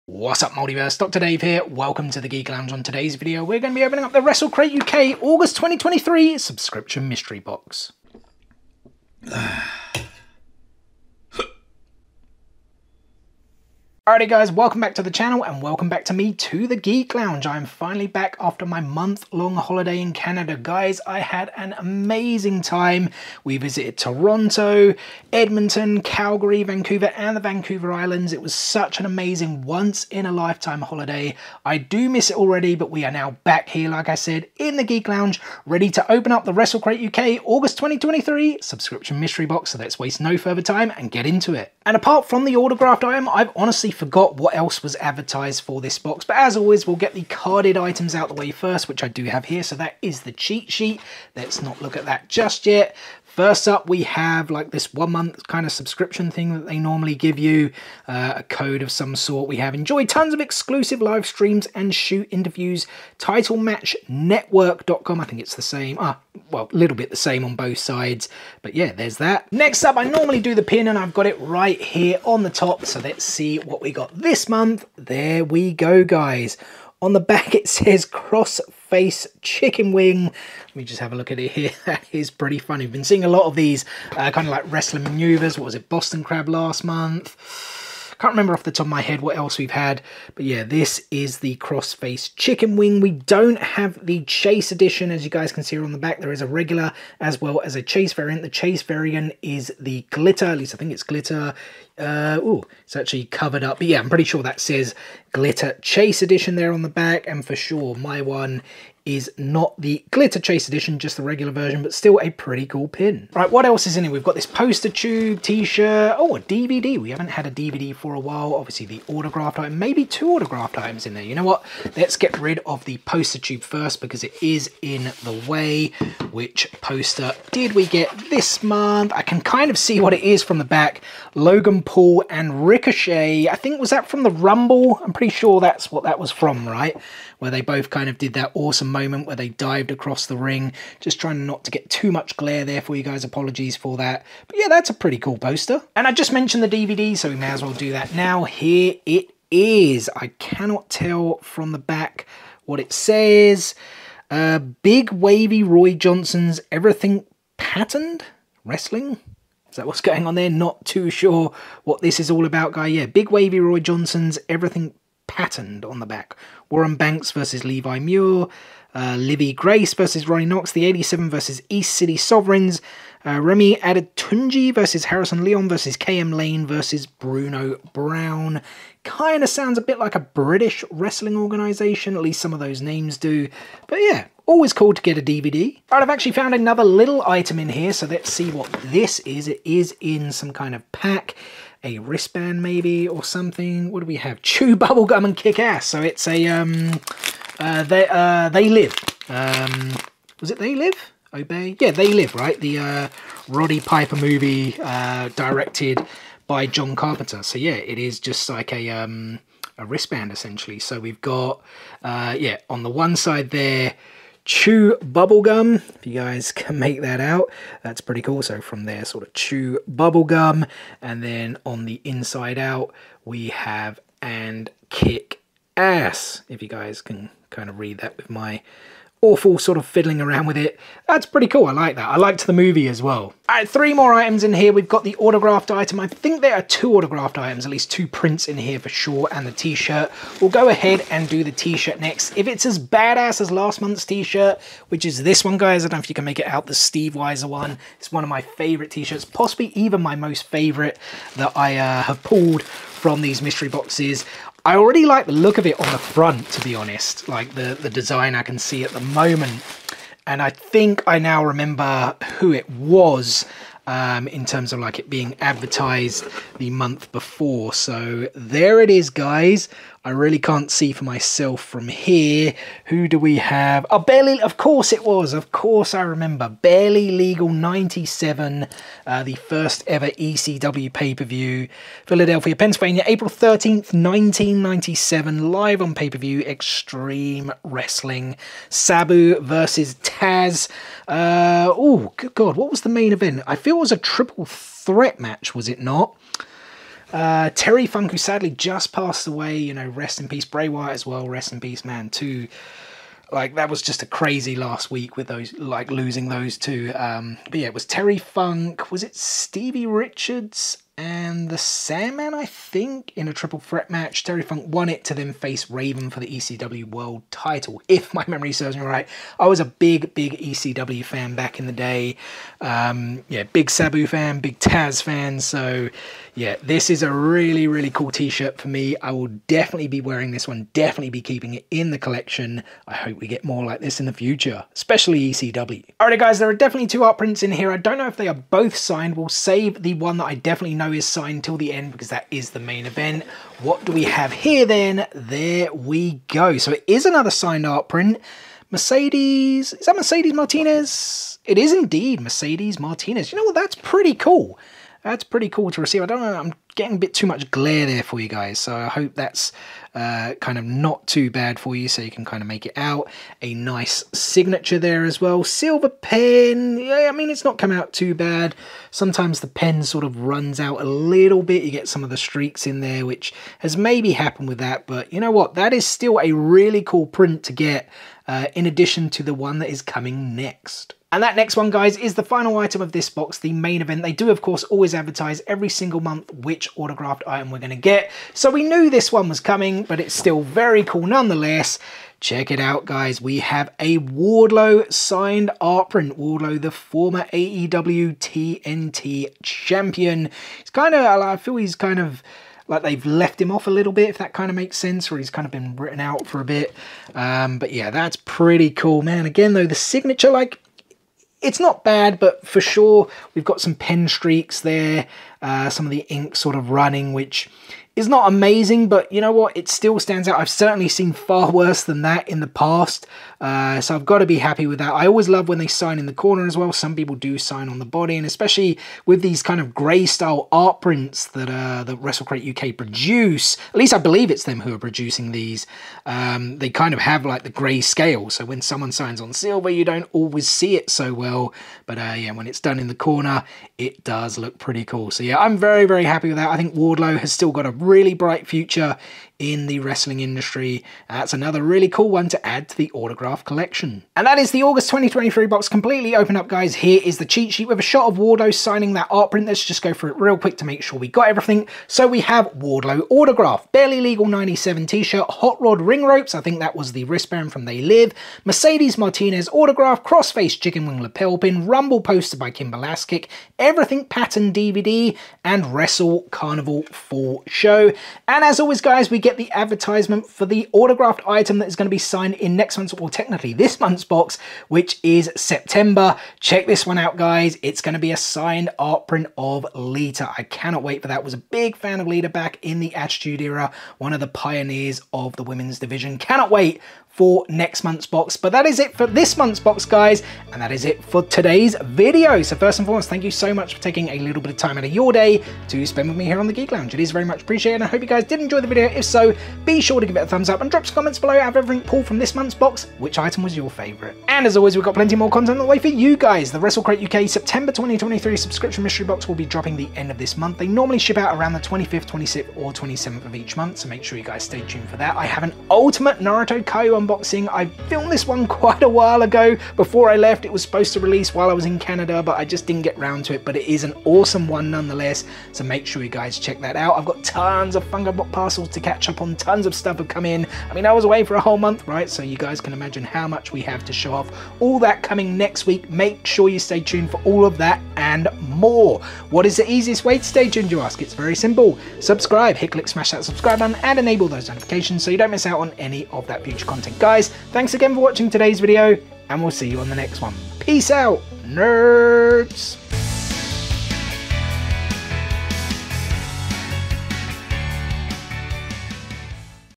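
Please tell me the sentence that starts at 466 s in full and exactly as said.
I think that was the wristband from They Live.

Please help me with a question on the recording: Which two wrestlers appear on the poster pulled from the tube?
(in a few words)
Logan and Ricochet.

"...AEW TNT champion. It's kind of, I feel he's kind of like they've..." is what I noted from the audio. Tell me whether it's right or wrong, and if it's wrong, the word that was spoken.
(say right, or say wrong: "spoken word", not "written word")
right.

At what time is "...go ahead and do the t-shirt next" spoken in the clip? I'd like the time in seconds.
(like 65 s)
240 s.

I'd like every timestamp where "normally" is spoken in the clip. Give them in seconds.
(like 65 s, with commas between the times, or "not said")
56 s, 70 s, 520 s.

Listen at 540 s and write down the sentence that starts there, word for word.
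I mean, I was away for a whole month, right?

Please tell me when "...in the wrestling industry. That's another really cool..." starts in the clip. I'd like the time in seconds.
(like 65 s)
449 s.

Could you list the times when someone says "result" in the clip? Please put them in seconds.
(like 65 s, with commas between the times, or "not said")
not said.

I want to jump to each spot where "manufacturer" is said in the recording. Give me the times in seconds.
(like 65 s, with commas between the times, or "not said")
not said.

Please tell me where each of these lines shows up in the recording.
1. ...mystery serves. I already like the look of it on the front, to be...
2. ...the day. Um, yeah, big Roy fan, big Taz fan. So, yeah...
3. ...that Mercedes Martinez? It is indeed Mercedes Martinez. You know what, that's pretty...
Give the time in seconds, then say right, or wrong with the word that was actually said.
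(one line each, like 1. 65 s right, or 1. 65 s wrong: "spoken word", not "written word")
1. 253 s wrong: "boxes", not "serves"
2. 321 s wrong: "Sabu", not "Roy"
3. 349 s right.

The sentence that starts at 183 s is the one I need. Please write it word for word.
But yeah, always cool to get a DVD.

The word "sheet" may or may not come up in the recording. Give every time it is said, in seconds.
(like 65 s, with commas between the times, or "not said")
50 s, 457 s.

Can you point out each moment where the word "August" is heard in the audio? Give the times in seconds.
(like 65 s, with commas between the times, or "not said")
5 s, 37 s, 454 s.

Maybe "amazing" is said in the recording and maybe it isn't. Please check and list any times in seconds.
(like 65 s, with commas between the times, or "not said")
21 s, 29 s, 418 s.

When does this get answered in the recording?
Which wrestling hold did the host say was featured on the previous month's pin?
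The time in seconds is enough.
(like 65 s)
85 s.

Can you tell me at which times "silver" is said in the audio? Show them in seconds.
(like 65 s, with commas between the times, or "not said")
365 s, 439 s.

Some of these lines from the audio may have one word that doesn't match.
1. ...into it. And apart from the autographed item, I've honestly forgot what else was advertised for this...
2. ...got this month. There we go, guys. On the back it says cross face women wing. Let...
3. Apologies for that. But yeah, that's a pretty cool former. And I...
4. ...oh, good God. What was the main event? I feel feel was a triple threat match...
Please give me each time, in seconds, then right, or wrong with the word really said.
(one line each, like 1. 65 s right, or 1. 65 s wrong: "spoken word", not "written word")
1. 41 s right
2. 73 s wrong: "chicken", not "women"
3. 143 s wrong: "poster", not "former"
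4. 291 s right.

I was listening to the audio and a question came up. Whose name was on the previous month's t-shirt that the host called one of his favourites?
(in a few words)
Steve Weiser.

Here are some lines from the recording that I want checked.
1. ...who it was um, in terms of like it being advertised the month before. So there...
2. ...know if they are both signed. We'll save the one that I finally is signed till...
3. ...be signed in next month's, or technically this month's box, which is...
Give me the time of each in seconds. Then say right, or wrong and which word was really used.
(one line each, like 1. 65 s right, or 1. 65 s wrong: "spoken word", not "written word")
1. 262 s right
2. 337 s wrong: "definitely", not "finally"
3. 481 s right.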